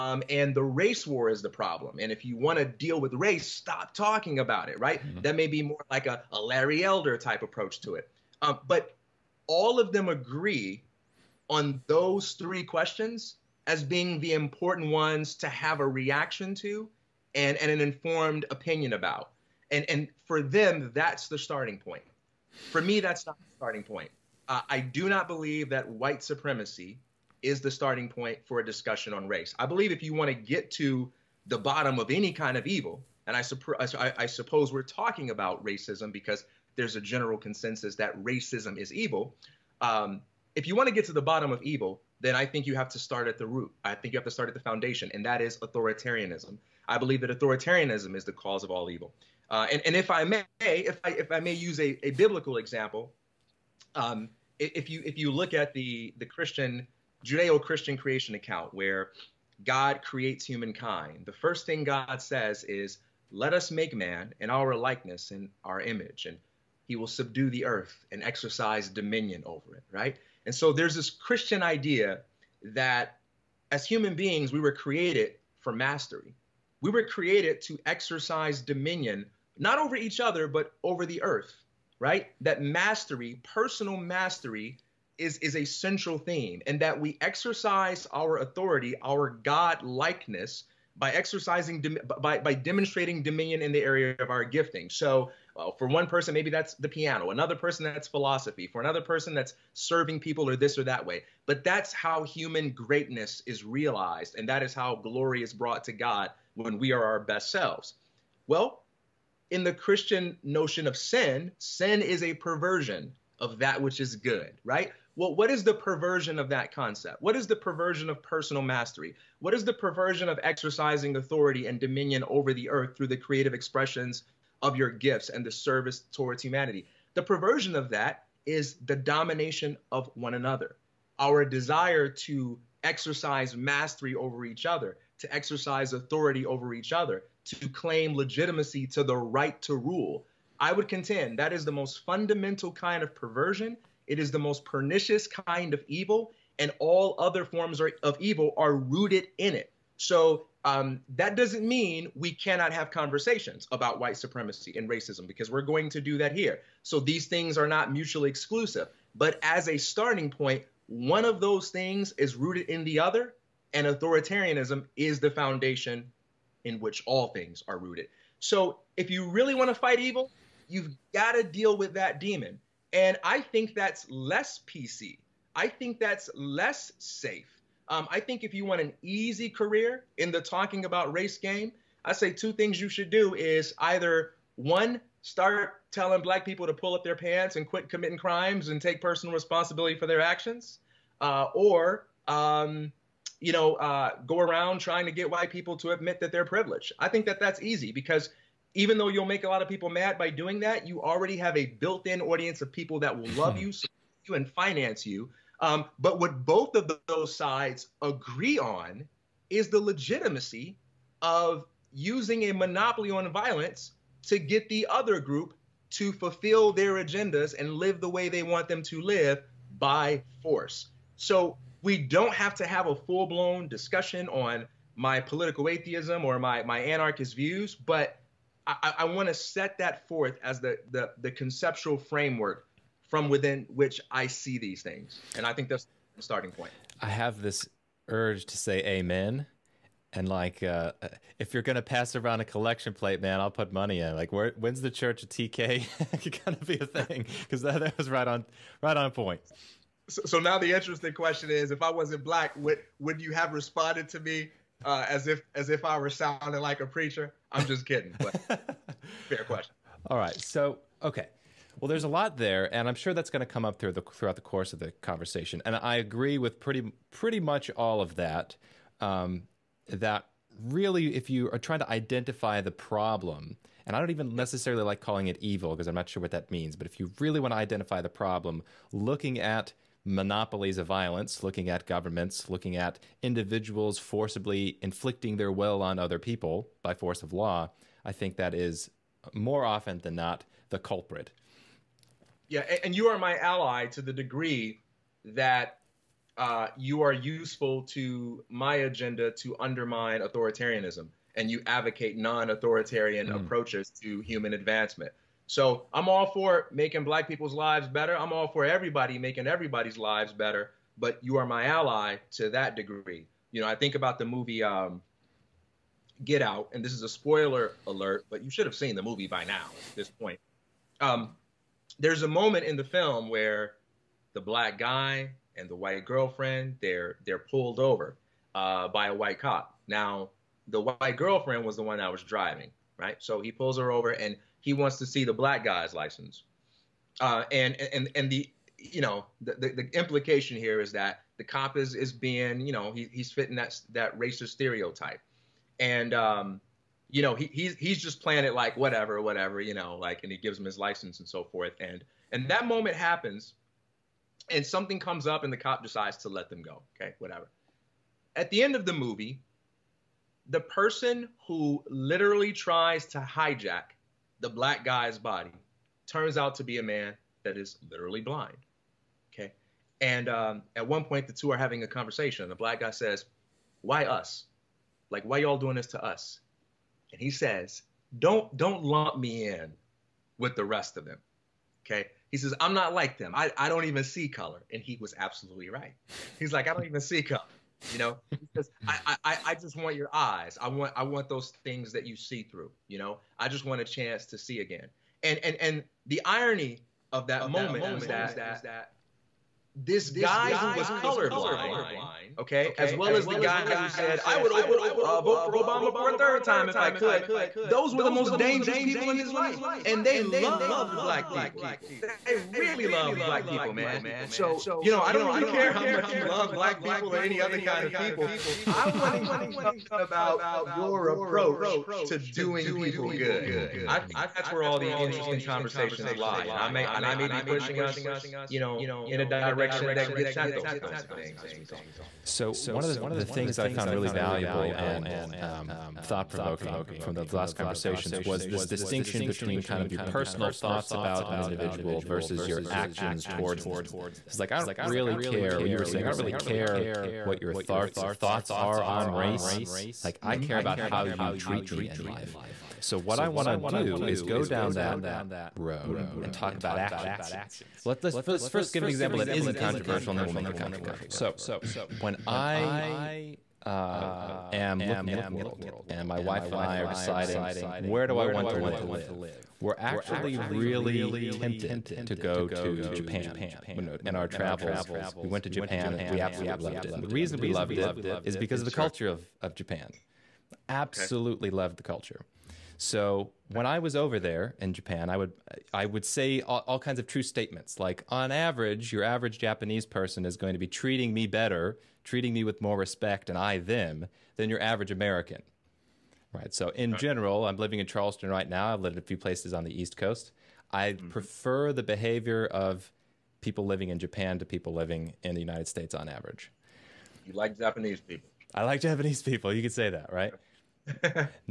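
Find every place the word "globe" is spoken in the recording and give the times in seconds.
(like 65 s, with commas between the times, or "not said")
not said.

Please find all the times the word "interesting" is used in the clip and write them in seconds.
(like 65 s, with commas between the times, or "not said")
250 s, 424 s.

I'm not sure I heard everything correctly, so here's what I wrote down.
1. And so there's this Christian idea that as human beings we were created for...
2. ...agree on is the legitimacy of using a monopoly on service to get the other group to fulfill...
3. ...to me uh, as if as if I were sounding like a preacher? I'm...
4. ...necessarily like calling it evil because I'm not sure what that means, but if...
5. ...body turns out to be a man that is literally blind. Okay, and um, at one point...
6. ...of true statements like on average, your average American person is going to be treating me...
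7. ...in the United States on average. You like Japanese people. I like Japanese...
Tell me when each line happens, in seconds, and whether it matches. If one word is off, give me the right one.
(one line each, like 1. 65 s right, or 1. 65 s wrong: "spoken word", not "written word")
1. 70 s right
2. 208 s wrong: "violence", not "service"
3. 254 s right
4. 274 s right
5. 365 s right
6. 486 s wrong: "Japanese", not "American"
7. 505 s right.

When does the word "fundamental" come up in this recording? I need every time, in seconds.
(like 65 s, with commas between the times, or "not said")
142 s.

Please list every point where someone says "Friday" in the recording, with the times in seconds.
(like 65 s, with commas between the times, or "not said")
not said.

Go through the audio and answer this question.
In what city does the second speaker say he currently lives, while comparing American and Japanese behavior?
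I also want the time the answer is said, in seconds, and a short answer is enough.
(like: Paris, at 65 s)
Charleston, at 497 s.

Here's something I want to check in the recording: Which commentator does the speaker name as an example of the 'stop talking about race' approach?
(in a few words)
Larry Elder.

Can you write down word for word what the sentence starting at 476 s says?
And the reason we loved it is because of the sure.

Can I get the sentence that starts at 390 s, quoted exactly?
I want I want those things that you see through.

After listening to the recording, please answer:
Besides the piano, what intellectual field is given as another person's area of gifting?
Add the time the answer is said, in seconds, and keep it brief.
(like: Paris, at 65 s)
Philosophy, at 98 s.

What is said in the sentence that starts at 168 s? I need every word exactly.
So if you really want to fight evil, you've got to deal with that demon.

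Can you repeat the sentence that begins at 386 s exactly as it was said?
He's like, I don't even see color.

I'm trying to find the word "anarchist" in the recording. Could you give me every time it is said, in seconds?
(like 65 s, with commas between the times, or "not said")
226 s.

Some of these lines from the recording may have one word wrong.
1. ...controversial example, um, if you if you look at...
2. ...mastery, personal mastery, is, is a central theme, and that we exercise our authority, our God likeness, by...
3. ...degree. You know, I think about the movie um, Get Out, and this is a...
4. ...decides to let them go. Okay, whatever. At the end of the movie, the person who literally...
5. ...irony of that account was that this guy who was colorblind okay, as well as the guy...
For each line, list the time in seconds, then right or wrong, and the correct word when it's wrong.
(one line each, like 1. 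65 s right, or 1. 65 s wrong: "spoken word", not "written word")
1. 52 s wrong: "biblical", not "controversial"
2. 82 s right
3. 312 s right
4. 355 s right
5. 396 s wrong: "moment", not "account".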